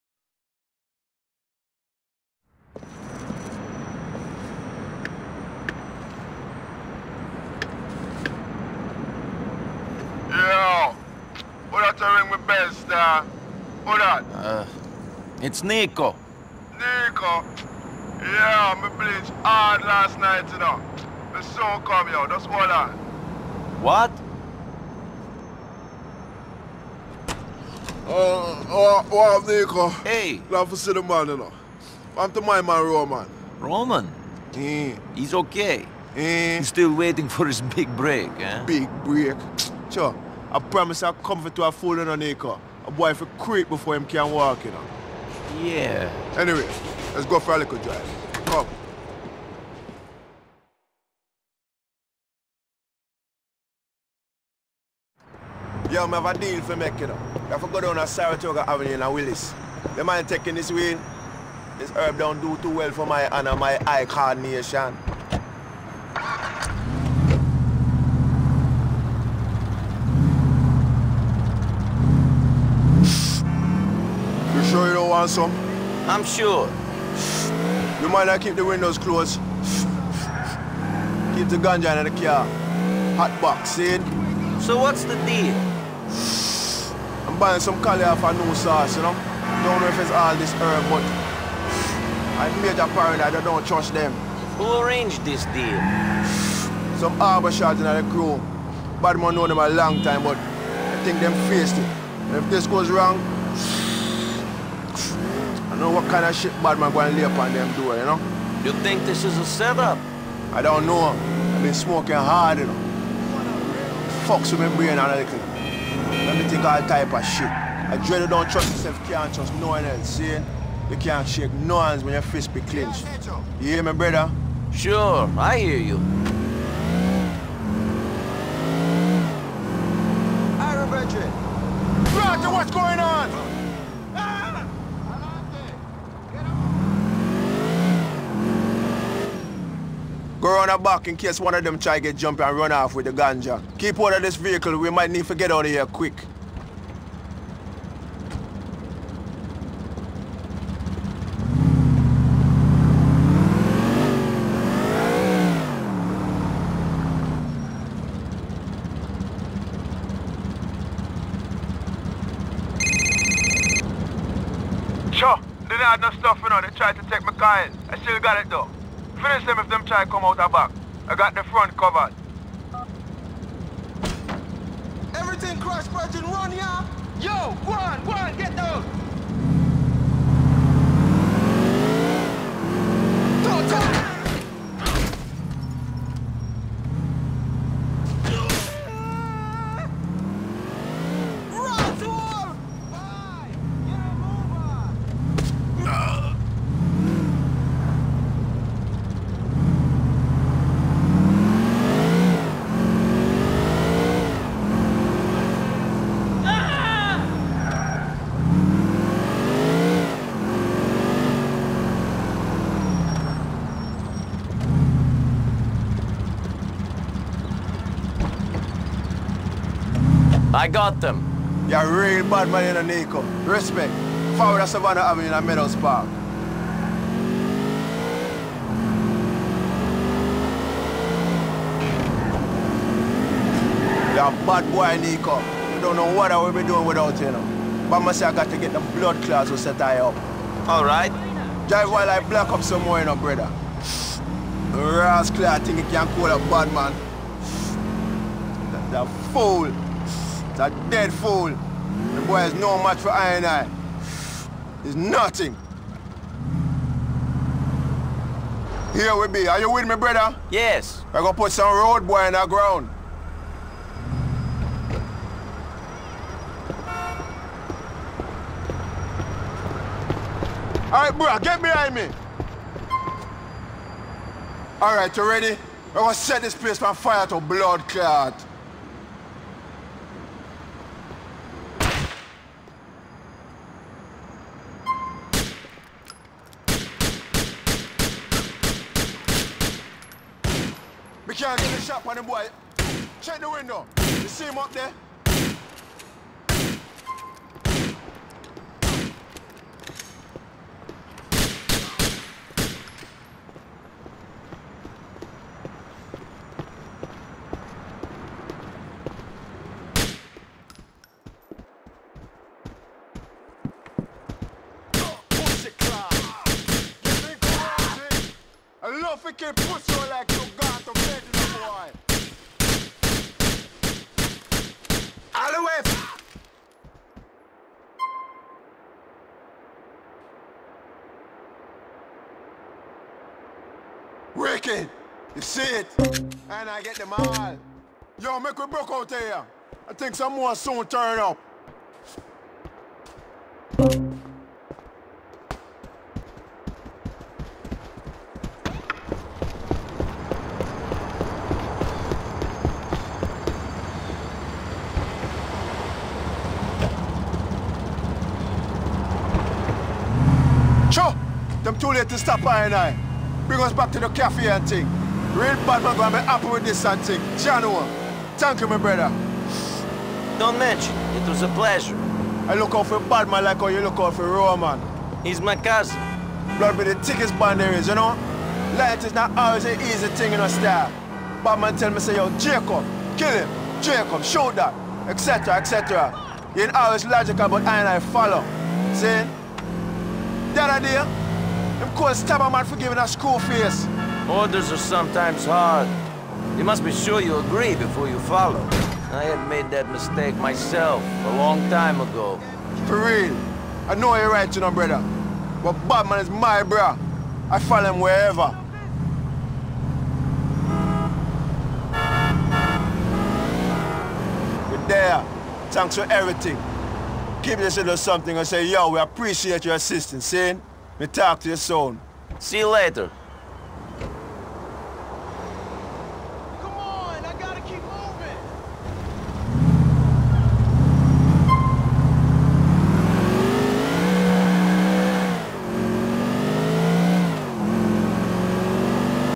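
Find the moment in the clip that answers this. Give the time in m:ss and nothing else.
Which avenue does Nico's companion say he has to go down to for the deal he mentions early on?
0:58.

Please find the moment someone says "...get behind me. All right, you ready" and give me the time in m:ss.
4:31.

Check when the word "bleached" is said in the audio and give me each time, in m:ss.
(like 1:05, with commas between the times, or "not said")
0:18.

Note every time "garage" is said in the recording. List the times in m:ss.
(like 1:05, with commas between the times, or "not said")
not said.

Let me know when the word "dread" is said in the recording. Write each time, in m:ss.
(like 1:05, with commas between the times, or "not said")
1:58.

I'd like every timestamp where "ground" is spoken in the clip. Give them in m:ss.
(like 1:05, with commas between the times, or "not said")
4:22.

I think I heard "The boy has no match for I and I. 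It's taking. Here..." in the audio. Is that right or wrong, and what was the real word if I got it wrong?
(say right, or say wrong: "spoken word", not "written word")
wrong: "nothing", not "taking".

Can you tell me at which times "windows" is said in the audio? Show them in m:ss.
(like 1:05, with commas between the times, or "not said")
1:18, 4:53.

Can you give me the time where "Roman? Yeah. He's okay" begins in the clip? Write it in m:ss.
0:33.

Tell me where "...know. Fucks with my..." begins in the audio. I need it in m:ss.
1:52.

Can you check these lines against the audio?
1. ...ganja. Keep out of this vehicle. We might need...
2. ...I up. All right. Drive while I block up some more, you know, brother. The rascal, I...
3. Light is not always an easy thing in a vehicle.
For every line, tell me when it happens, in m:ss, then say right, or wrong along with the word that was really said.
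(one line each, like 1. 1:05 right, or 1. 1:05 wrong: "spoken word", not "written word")
1. 2:23 right
2. 3:59 right
3. 6:18 wrong: "style", not "vehicle".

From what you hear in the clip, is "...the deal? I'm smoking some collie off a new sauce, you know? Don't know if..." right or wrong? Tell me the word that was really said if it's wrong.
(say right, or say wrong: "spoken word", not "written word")
wrong: "buying", not "smoking".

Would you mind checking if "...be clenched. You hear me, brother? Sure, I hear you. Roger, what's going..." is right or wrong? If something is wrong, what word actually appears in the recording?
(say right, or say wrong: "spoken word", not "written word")
right.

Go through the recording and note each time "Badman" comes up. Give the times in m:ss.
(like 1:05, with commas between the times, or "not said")
1:39, 1:46, 6:45.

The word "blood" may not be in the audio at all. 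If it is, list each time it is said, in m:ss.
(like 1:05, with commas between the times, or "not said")
3:58, 4:37, 6:16.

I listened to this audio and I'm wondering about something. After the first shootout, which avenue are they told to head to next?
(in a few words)
Savannah Avenue.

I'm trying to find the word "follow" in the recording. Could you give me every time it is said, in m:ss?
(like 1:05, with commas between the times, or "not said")
6:27, 6:38, 6:47.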